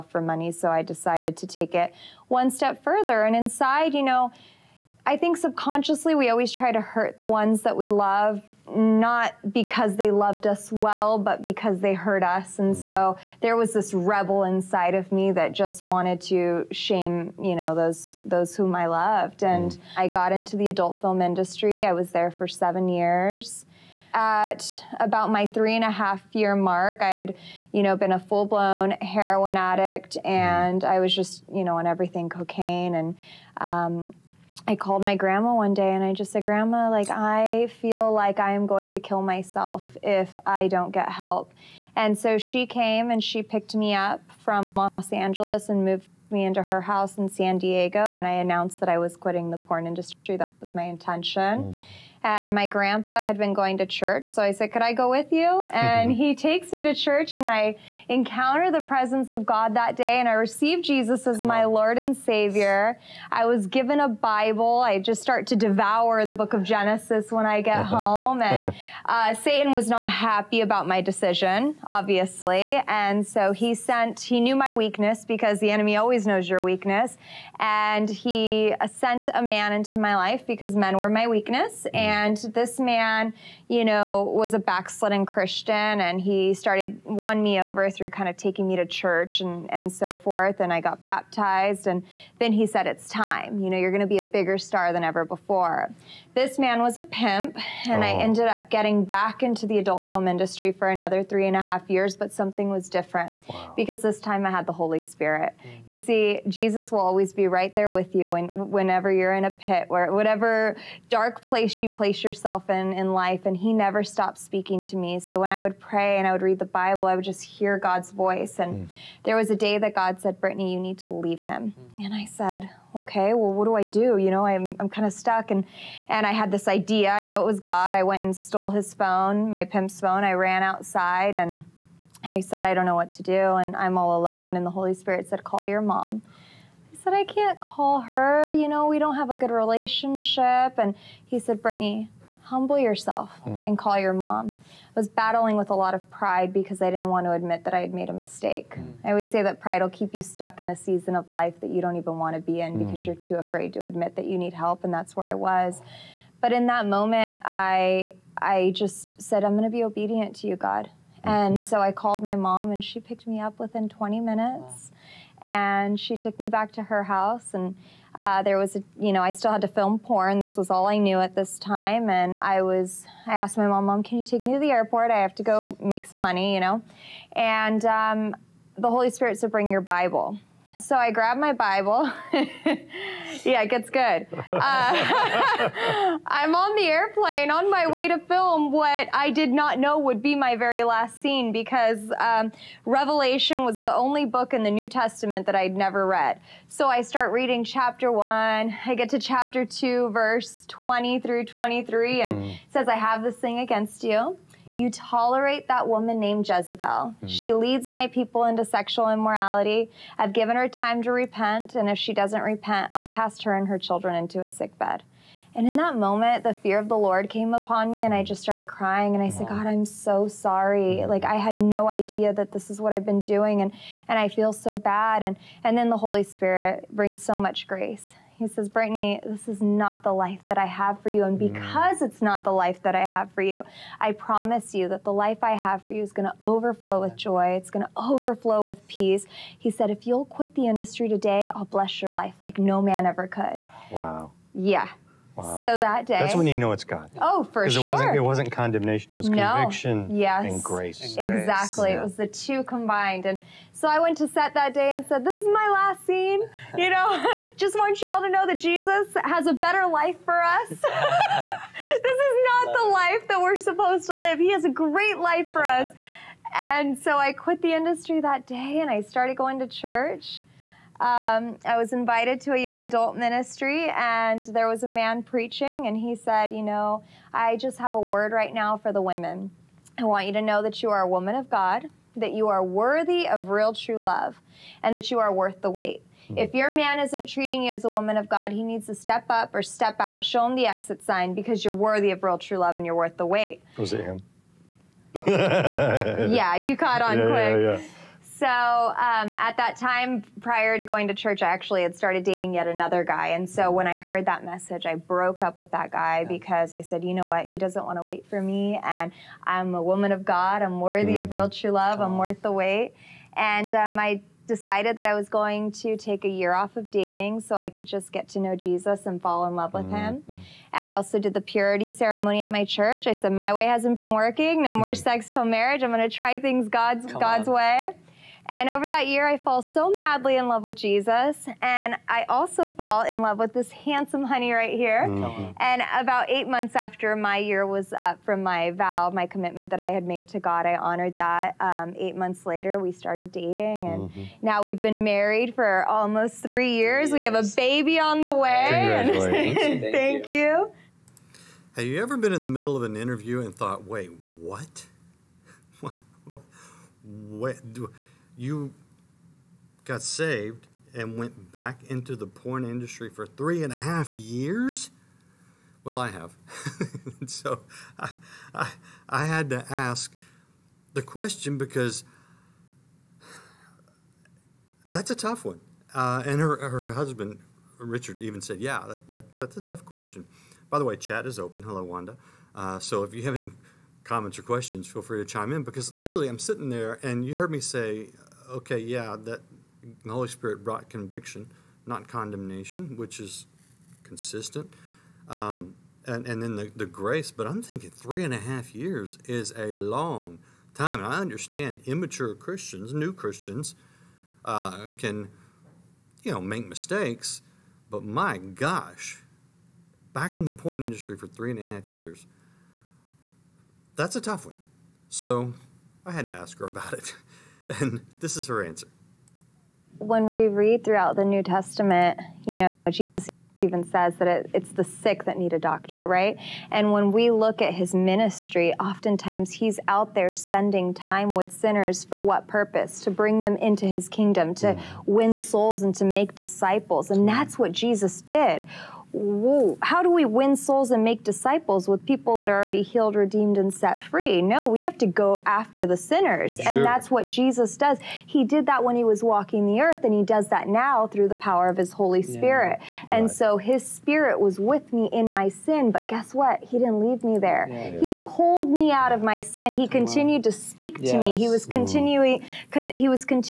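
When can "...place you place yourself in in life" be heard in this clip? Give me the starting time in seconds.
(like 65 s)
111 s.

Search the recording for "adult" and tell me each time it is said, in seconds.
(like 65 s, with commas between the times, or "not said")
20 s, 99 s, 272 s.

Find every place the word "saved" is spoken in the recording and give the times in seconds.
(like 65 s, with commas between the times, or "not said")
360 s.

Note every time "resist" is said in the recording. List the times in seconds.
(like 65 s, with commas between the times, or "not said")
not said.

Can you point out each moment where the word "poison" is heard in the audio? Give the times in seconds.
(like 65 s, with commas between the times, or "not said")
not said.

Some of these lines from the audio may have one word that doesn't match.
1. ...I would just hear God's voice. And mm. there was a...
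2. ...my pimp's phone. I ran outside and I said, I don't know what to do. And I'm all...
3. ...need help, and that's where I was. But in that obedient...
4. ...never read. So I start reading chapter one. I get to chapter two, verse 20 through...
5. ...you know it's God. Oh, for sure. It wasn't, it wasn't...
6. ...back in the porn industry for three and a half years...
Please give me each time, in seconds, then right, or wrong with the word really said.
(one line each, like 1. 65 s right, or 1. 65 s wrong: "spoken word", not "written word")
1. 117 s right
2. 129 s right
3. 154 s wrong: "moment", not "obedient"
4. 195 s right
5. 246 s right
6. 410 s right.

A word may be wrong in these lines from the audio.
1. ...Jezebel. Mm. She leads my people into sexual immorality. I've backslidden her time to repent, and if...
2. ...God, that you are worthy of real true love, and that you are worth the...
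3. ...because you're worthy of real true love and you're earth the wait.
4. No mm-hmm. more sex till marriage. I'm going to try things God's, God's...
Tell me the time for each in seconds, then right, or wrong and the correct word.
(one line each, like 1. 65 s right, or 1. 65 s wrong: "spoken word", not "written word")
1. 206 s wrong: "given", not "backslidden"
2. 281 s right
3. 291 s wrong: "worth", not "earth"
4. 324 s right.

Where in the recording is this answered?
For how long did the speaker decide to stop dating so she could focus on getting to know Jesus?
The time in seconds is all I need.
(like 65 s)
316 s.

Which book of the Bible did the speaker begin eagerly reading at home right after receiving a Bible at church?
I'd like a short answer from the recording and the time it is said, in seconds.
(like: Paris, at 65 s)
Genesis, at 66 s.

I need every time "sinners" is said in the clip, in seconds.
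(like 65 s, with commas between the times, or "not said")
431 s, 445 s.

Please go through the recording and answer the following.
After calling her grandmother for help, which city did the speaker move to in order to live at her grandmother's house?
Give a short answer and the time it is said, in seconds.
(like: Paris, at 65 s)
San Diego, at 47 s.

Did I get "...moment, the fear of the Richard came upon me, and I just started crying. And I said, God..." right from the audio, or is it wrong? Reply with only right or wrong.
wrong.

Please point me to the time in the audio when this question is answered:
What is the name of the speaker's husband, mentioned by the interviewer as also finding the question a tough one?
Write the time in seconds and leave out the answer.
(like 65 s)
377 s.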